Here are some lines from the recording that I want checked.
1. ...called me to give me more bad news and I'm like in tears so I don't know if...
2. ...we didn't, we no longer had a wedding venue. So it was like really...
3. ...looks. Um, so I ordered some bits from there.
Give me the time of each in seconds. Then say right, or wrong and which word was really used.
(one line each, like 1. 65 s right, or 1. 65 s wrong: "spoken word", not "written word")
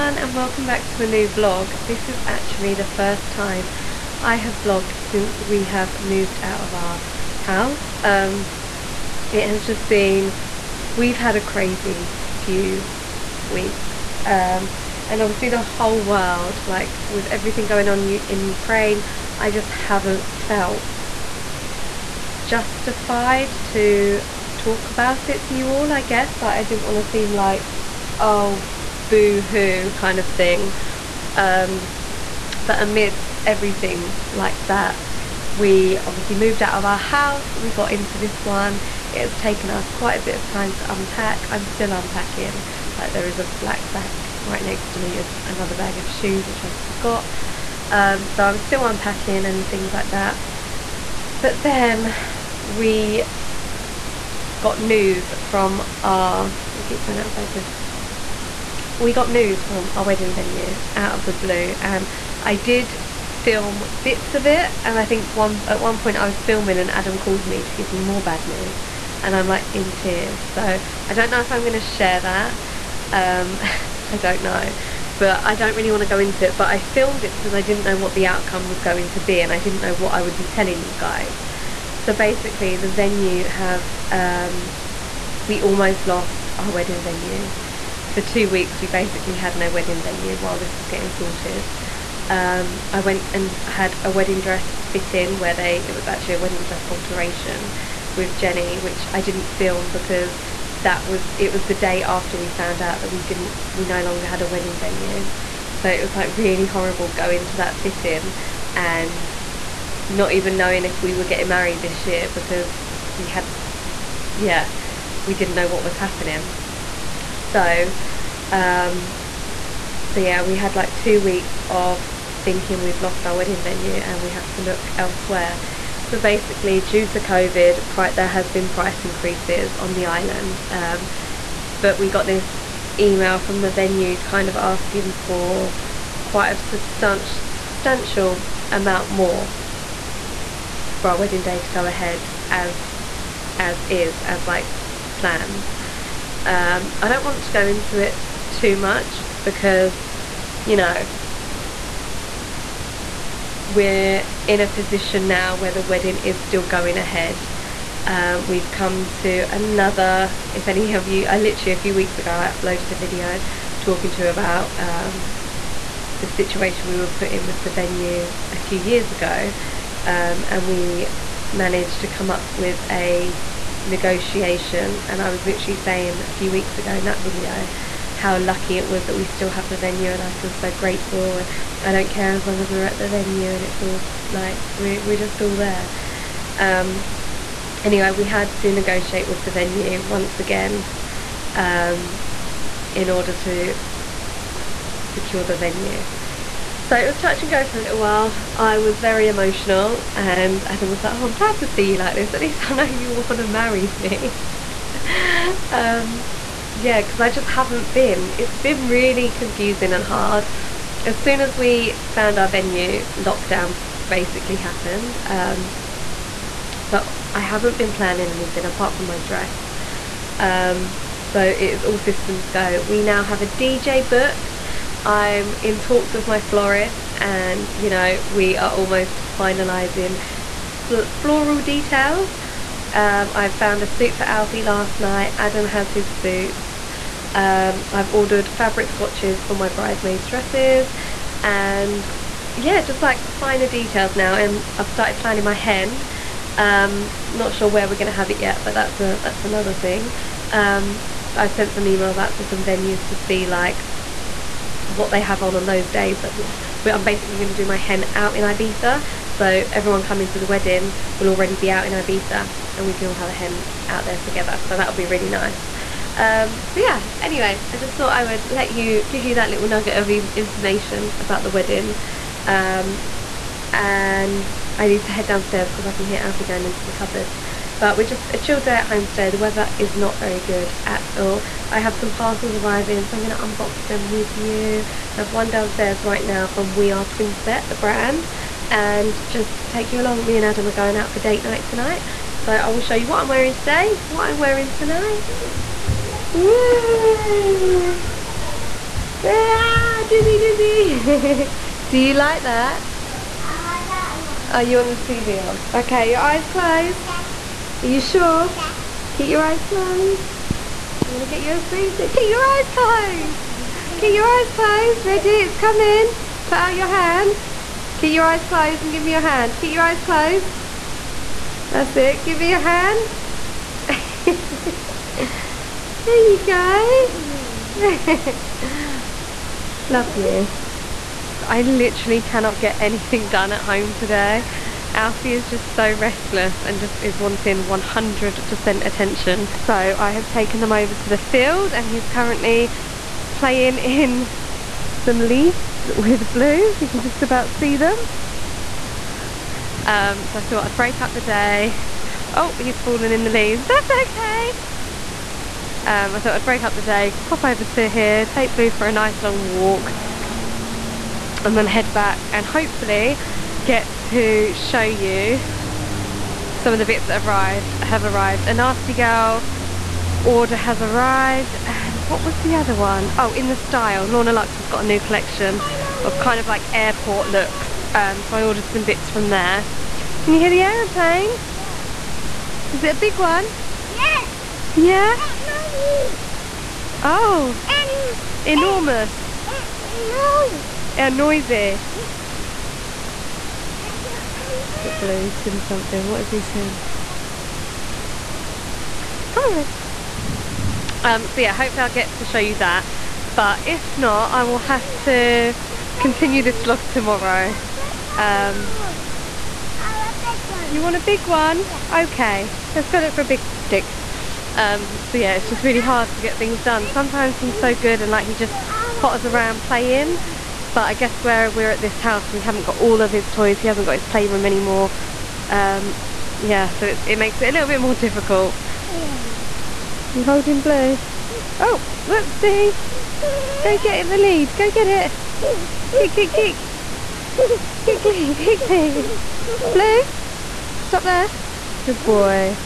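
1. 67 s right
2. 103 s right
3. 377 s right.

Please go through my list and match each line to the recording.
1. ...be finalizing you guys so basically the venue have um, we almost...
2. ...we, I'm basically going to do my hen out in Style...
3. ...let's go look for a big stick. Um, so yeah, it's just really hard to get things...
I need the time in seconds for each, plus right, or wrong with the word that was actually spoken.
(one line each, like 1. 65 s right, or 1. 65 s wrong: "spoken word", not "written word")
1. 80 s wrong: "telling", not "finalizing"
2. 256 s wrong: "Ibiza", not "Style"
3. 412 s right.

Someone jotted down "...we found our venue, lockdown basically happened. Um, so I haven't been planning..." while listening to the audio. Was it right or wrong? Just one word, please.
right.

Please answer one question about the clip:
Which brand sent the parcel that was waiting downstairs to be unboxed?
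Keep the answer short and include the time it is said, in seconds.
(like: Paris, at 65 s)
We Are Twinset, at 286 s.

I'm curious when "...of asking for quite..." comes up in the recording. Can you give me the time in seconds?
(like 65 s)
134 s.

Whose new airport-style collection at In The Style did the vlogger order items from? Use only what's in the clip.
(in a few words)
Lorna Luxe.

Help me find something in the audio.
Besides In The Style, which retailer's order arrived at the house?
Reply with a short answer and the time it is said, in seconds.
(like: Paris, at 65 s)
Nasty Gal, at 368 s.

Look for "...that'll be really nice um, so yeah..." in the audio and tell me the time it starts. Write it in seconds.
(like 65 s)
264 s.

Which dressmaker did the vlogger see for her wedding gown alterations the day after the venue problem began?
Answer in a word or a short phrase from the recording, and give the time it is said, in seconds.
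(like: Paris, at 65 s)
Jenny, at 98 s.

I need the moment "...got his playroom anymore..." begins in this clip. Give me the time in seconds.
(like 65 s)
423 s.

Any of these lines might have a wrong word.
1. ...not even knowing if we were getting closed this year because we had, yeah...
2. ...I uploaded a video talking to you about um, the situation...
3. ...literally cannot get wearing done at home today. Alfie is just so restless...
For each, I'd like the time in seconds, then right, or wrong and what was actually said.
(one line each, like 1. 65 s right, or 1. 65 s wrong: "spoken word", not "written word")
1. 110 s wrong: "married", not "closed"
2. 162 s right
3. 331 s wrong: "anything", not "wearing".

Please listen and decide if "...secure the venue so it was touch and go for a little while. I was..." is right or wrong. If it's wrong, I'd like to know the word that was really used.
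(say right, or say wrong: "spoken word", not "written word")
right.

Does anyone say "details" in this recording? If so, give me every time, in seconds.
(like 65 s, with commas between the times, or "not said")
231 s, 243 s.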